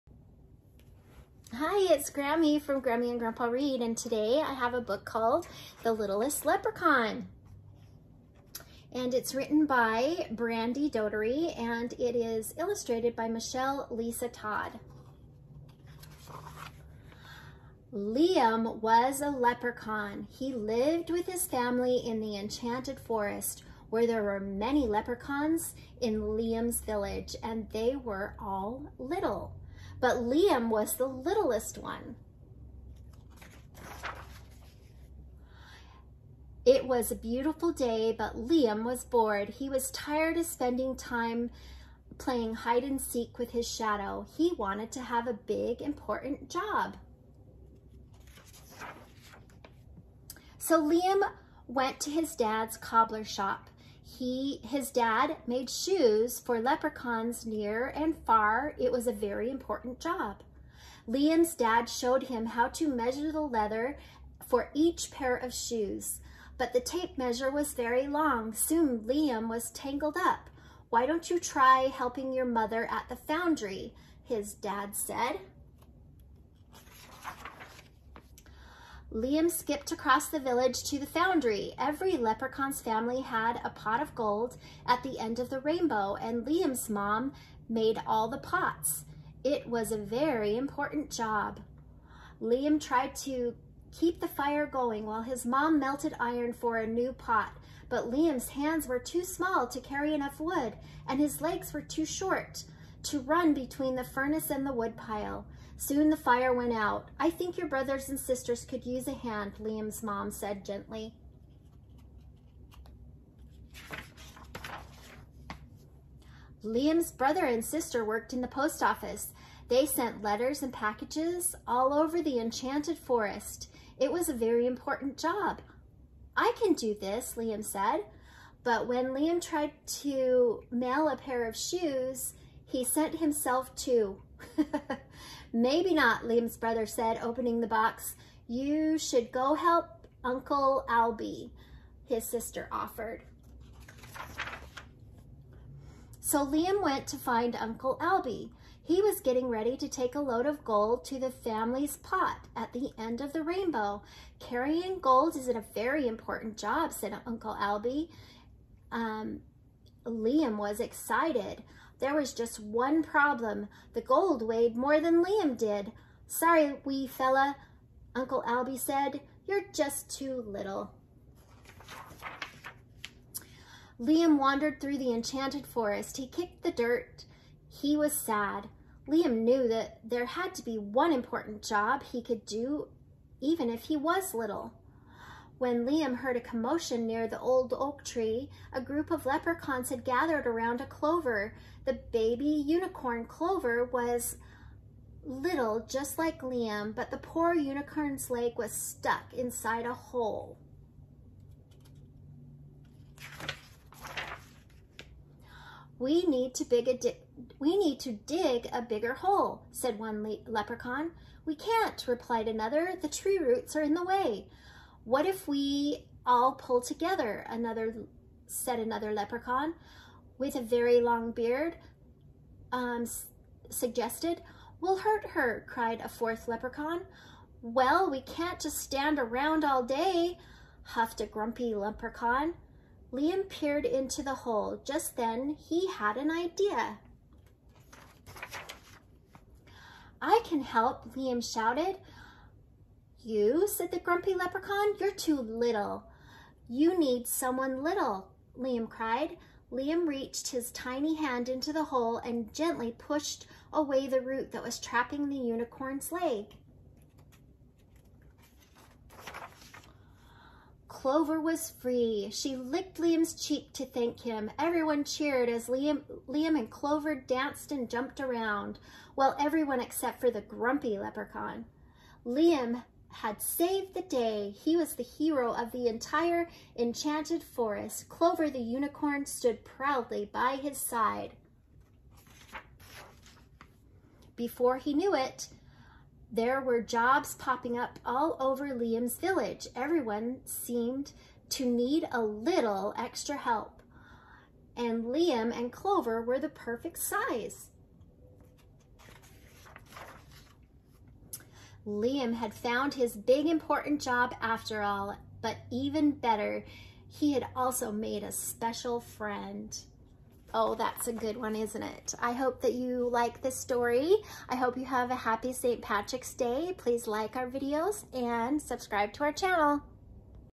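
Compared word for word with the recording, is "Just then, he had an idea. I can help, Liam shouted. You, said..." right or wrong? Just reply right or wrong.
right.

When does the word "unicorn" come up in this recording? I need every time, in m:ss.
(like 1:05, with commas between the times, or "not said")
3:12, 3:17, 4:15, 4:38.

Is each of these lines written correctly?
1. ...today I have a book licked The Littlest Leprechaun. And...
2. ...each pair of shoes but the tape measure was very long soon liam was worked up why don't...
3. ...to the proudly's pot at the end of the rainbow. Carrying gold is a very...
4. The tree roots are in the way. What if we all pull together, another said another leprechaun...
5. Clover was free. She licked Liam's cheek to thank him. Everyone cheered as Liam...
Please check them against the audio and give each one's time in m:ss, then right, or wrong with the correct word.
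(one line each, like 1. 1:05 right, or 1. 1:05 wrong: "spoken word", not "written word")
1. 0:03 wrong: "called", not "licked"
2. 1:04 wrong: "tangled", not "worked"
3. 2:31 wrong: "family", not "proudly"
4. 3:32 right
5. 4:20 right.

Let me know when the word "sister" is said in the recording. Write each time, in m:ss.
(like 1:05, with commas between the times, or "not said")
1:48, 1:57, 2:22.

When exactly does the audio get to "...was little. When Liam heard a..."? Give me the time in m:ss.
3:03.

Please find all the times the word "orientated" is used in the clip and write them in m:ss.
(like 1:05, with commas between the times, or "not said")
not said.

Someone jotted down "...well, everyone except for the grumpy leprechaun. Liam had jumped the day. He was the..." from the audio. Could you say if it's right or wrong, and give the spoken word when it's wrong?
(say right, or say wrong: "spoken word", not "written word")
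wrong: "saved", not "jumped".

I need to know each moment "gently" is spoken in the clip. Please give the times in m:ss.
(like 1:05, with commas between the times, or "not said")
1:50, 4:12.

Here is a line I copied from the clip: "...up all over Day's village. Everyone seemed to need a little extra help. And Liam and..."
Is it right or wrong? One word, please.
wrong.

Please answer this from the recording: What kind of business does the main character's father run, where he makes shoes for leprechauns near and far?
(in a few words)
cobbler shop.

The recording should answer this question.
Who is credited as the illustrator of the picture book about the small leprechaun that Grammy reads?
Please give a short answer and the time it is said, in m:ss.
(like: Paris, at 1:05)
Michelle Lisa Todd, at 0:13.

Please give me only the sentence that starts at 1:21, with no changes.
Every leprechaun's family had a pot of gold at the end of the rainbow, and Liam's mom made all the pots.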